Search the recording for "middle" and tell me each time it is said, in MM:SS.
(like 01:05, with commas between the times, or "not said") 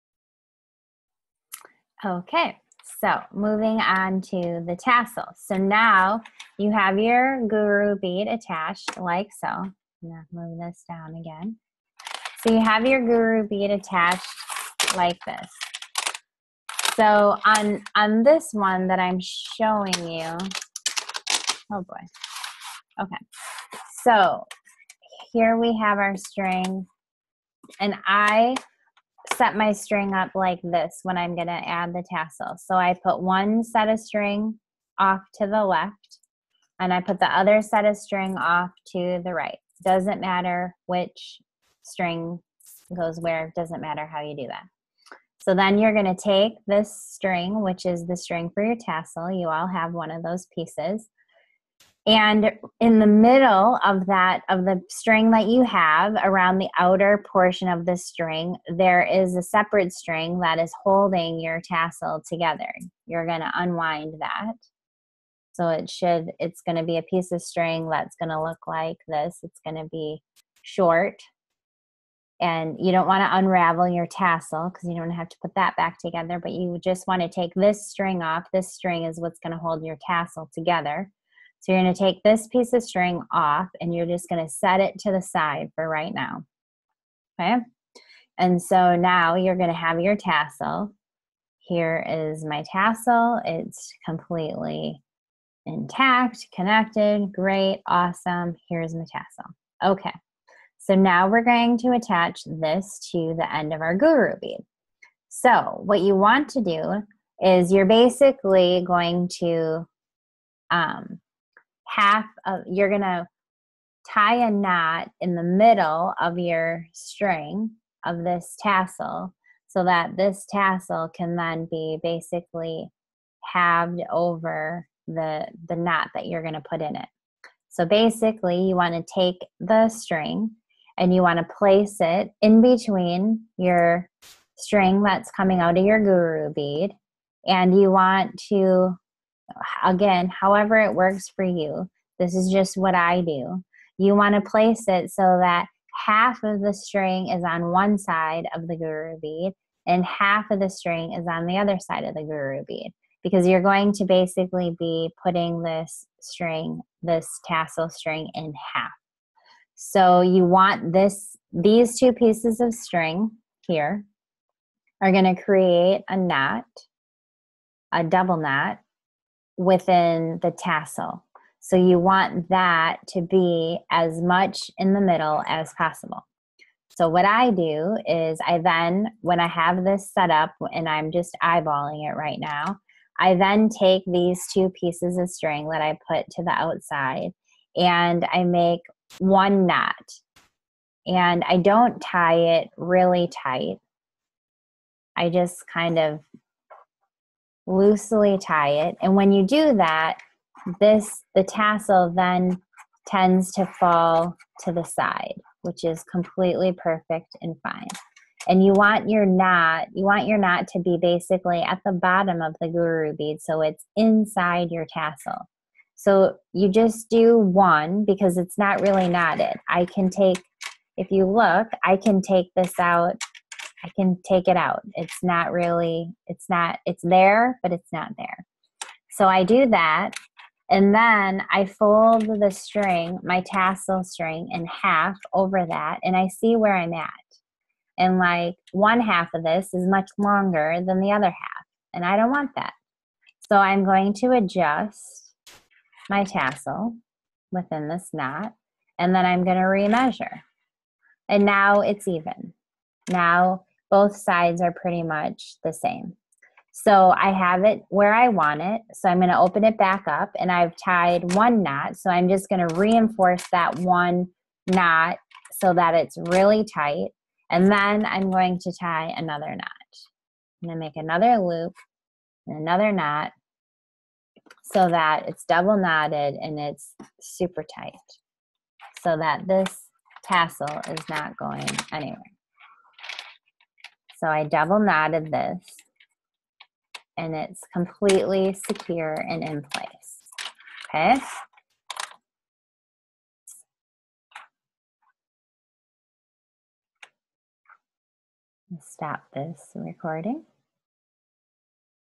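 00:53, 01:55, 02:55.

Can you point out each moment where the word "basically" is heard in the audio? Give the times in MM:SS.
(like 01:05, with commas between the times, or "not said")
01:47, 02:02, 02:07, 02:34, 03:30.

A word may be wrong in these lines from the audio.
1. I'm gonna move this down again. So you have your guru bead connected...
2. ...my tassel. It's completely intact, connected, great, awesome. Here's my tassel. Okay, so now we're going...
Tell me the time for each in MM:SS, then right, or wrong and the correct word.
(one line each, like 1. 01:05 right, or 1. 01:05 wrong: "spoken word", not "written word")
1. 00:09 wrong: "attached", not "connected"
2. 01:32 right.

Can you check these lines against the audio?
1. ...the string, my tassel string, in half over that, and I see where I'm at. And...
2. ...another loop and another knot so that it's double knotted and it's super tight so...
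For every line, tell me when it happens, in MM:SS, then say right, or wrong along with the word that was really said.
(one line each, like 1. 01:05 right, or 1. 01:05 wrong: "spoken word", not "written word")
1. 03:52 right
2. 04:30 right.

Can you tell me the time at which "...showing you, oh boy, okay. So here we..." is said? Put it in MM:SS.
00:19.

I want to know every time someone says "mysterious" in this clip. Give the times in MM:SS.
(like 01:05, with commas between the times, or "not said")
not said.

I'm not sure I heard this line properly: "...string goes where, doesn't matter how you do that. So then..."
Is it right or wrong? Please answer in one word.
right.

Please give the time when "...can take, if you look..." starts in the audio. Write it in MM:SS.
03:39.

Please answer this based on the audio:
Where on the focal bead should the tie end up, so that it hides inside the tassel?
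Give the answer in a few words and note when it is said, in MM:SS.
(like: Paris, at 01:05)
the bottom, at 03:31.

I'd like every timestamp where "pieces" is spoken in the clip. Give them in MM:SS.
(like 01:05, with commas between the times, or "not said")
00:50, 01:07, 01:22, 02:42, 03:04.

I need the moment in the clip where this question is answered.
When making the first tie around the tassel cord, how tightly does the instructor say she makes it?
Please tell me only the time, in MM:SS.
03:17.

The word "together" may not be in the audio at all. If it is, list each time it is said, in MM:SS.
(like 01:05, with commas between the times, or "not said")
01:02, 01:15, 01:20.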